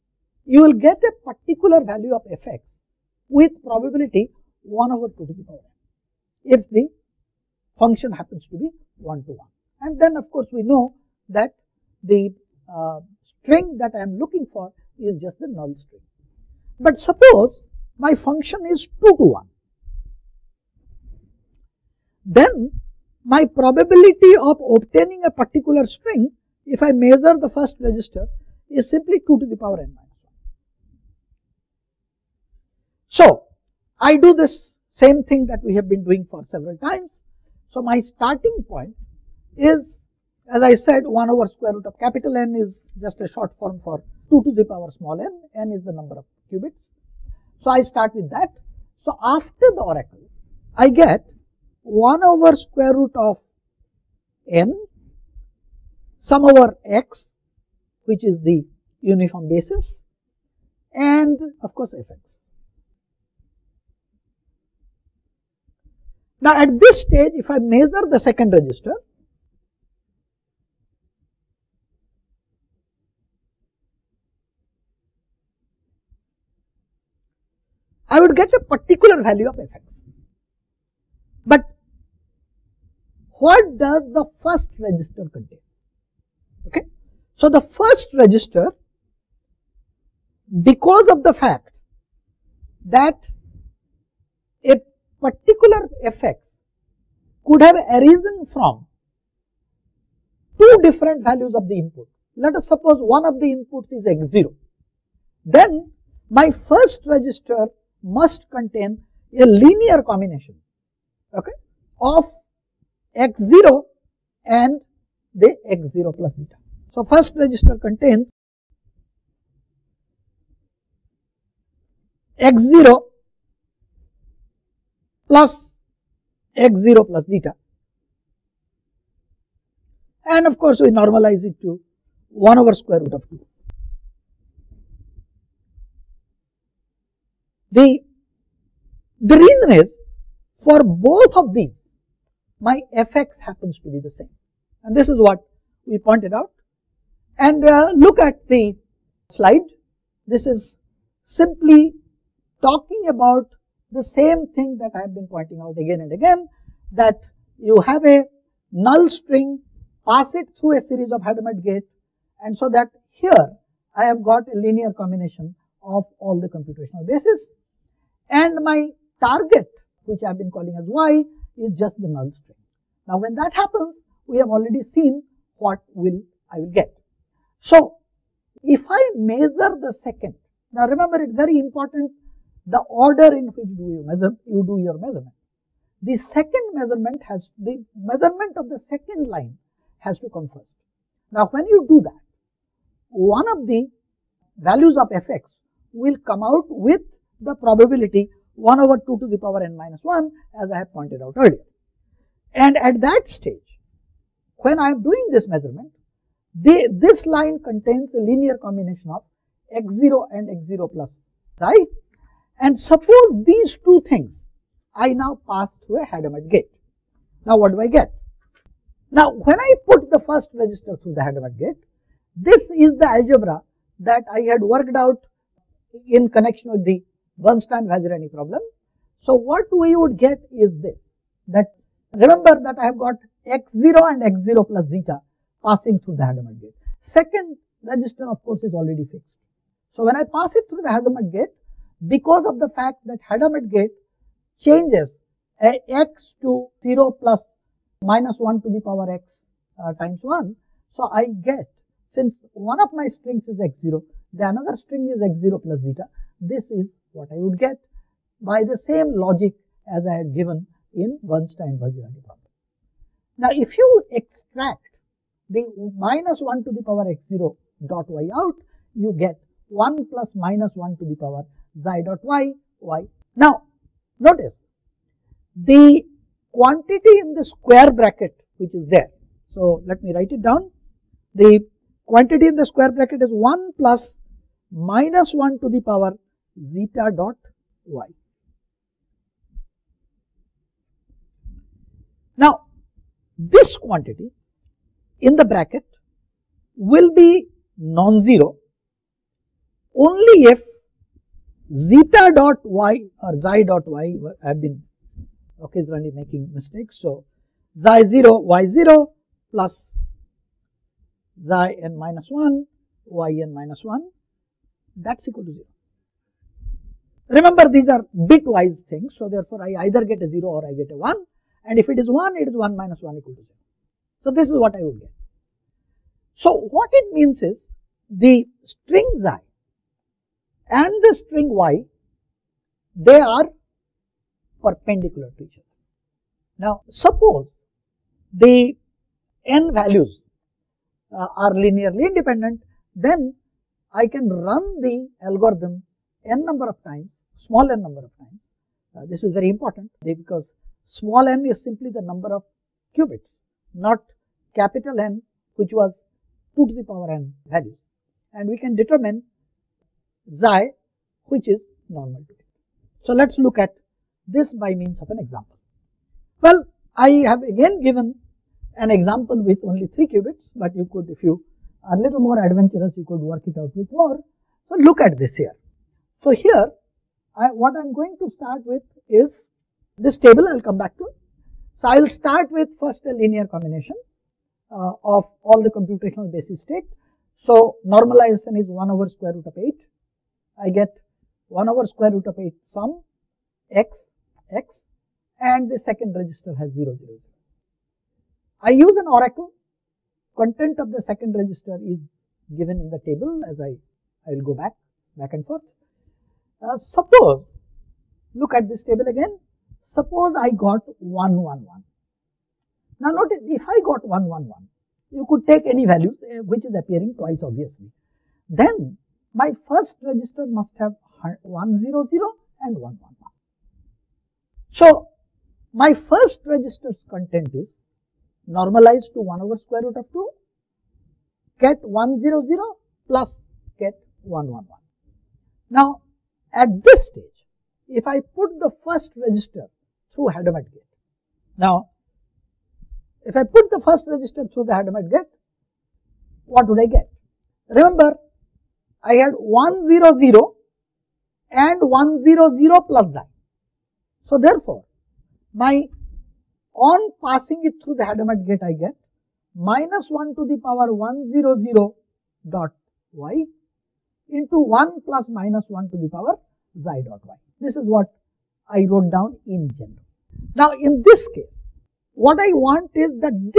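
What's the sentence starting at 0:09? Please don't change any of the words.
And then of course we know that the uh, string that I am looking for is just the null string.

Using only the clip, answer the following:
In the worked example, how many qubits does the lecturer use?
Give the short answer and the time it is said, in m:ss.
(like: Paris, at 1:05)
3, at 6:09.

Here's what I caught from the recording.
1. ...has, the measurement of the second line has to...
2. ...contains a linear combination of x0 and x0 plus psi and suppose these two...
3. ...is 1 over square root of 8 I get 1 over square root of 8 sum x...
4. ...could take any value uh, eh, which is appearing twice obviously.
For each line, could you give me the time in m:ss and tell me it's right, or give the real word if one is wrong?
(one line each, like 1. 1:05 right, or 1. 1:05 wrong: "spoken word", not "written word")
1. 3:07 right
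2. 3:27 right
3. 6:28 right
4. 6:55 right.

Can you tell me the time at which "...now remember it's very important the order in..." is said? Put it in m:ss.
3:00.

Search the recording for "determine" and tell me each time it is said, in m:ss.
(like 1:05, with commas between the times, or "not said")
5:58.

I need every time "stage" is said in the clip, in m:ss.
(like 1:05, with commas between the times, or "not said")
1:07, 3:23, 7:17.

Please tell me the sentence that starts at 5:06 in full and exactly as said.
So, xi 0 y 0 plus xi n minus 1 y n minus 1 that is equal to 0.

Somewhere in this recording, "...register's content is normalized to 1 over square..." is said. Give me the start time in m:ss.
7:06.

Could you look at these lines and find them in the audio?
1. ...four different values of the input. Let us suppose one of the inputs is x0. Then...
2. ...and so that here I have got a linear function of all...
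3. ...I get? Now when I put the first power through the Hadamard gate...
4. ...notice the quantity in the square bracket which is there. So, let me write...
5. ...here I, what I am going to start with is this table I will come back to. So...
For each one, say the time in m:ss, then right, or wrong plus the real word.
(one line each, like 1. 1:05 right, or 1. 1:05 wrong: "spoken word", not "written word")
1. 1:40 wrong: "two", not "four"
2. 2:42 wrong: "combination", not "function"
3. 3:37 wrong: "register", not "power"
4. 4:34 right
5. 6:16 right.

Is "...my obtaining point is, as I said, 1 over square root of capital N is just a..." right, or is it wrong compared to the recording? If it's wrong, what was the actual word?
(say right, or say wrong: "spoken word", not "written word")
wrong: "starting", not "obtaining".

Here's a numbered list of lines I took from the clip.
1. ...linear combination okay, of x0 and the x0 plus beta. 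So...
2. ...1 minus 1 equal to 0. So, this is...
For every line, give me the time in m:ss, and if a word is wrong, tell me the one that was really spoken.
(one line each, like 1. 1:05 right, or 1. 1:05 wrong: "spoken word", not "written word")
1. 1:49 right
2. 5:22 right.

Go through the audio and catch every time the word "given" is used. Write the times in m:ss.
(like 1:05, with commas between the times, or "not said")
4:20, 6:07, 6:42.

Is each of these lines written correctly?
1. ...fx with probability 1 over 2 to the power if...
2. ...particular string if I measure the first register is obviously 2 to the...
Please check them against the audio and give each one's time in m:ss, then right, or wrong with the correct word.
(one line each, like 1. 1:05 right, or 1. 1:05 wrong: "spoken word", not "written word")
1. 0:02 right
2. 0:25 wrong: "simply", not "obviously".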